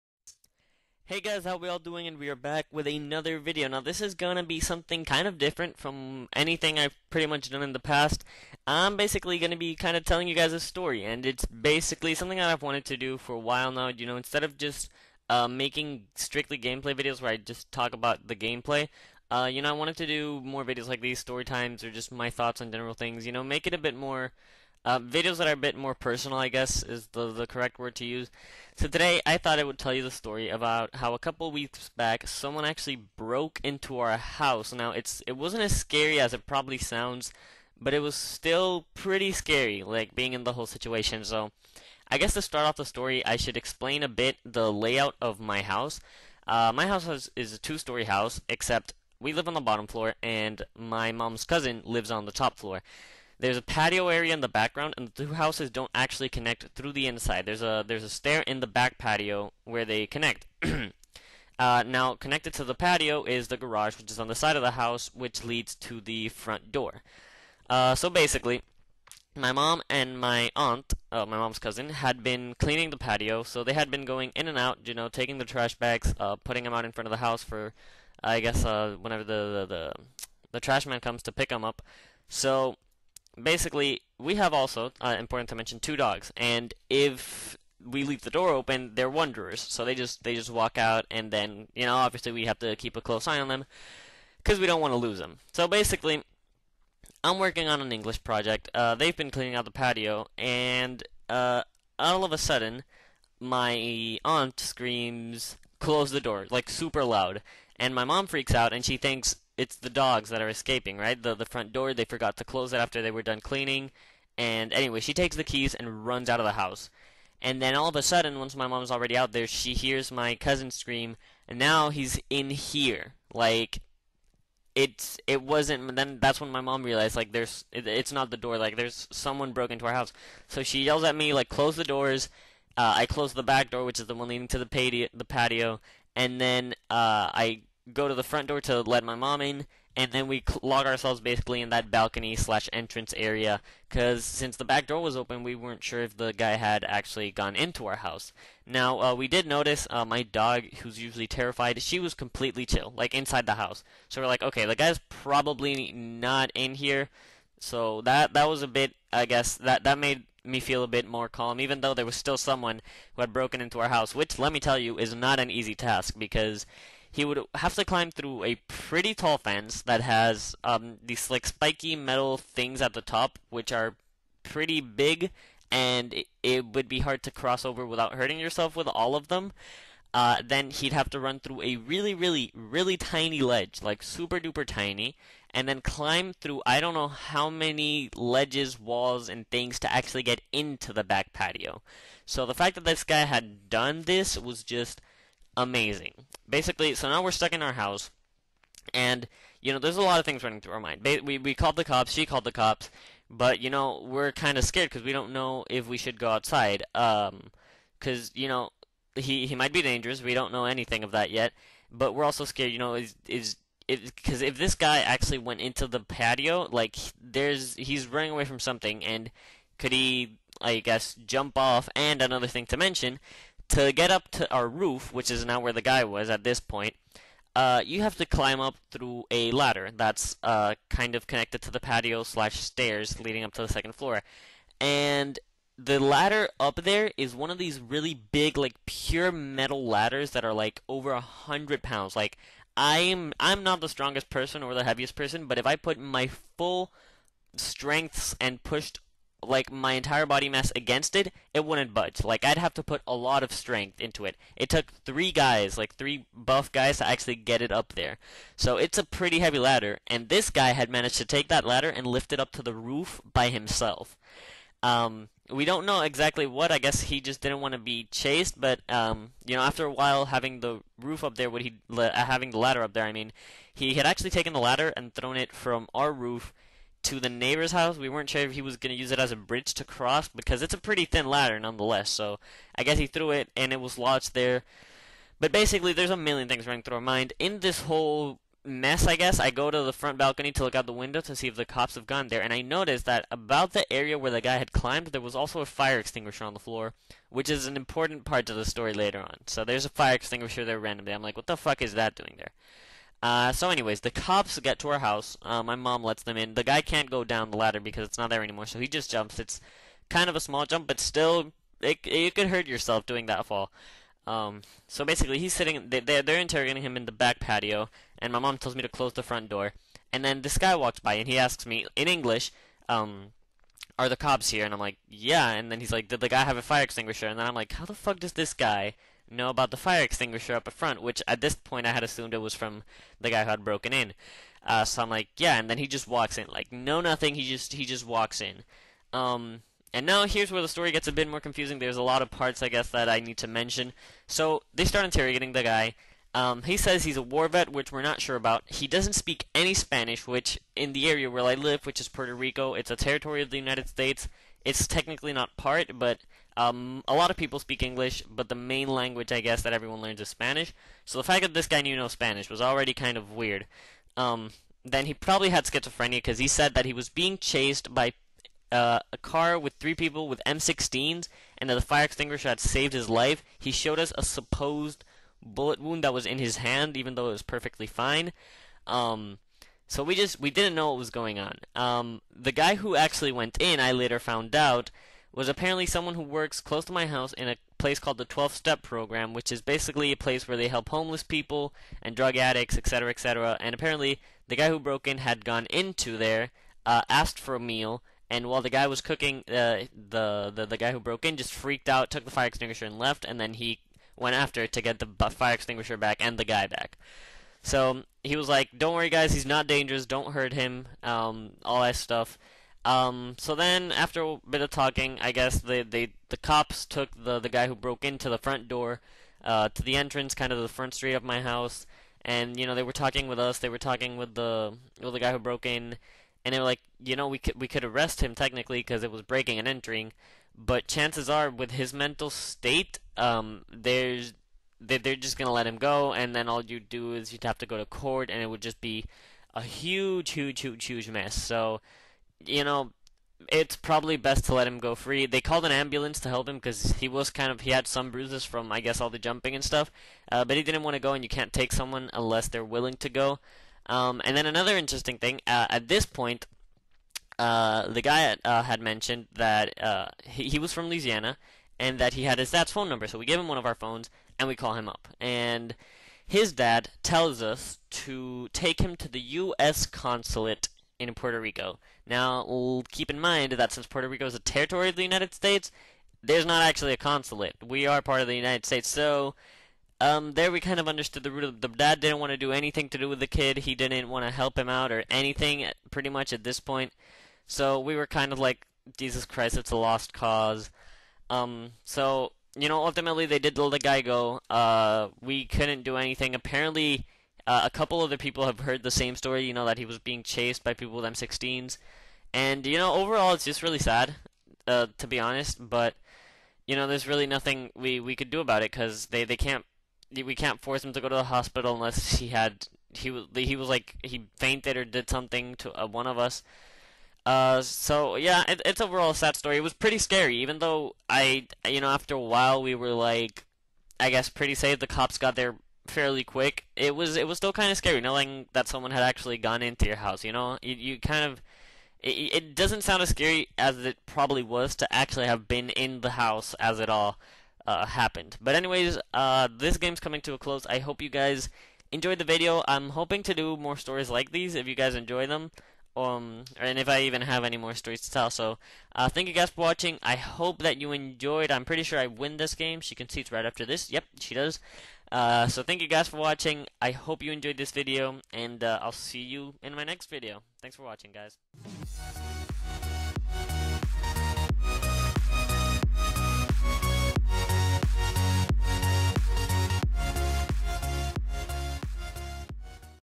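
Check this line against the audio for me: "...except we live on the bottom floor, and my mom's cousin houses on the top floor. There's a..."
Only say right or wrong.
wrong.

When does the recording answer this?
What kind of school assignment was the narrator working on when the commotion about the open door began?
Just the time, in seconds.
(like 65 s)
97 s.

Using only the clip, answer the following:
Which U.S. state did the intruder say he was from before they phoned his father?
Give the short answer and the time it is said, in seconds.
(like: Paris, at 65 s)
Louisiana, at 460 s.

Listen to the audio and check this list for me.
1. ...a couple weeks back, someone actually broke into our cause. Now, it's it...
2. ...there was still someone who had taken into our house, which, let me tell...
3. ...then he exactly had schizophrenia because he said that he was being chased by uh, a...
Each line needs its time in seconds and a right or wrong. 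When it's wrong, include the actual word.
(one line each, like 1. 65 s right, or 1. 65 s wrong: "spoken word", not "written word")
1. 31 s wrong: "house", not "cause"
2. 161 s wrong: "broken", not "taken"
3. 364 s wrong: "probably", not "exactly".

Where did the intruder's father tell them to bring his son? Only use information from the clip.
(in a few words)
U.S. consulate.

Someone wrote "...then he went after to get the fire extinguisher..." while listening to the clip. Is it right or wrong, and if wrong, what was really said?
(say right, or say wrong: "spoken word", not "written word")
right.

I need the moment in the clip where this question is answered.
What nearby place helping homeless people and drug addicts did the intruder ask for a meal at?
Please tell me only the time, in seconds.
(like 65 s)
388 s.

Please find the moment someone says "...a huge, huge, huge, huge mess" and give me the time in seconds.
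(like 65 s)
439 s.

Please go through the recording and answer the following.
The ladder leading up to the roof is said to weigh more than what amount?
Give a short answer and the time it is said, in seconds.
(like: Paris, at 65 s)
100 pounds, at 240 s.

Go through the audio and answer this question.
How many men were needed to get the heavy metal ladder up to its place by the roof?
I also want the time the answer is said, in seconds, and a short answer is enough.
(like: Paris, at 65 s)
3, at 255 s.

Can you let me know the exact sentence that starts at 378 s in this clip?
Um, so we just we didn't know what was going on.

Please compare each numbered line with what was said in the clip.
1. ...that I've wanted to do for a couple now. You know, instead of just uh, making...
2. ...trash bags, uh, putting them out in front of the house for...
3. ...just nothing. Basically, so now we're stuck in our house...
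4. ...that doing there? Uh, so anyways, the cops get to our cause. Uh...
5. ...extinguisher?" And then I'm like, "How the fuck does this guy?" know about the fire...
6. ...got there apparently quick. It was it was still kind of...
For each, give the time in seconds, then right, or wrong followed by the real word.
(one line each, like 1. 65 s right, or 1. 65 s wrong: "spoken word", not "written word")
1. 12 s wrong: "while", not "couple"
2. 75 s right
3. 194 s wrong: "amazing", not "nothing"
4. 301 s wrong: "house", not "cause"
5. 326 s right
6. 525 s wrong: "fairly", not "apparently".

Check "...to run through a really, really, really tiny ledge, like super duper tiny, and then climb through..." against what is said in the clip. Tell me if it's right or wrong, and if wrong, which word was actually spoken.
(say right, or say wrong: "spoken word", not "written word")
right.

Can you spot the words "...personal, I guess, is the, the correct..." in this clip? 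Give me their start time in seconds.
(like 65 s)
25 s.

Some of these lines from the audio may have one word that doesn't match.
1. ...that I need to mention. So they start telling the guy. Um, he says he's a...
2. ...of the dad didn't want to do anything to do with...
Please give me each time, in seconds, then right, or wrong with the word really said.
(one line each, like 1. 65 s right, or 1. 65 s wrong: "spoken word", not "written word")
1. 342 s wrong: "interrogating", not "telling"
2. 481 s right.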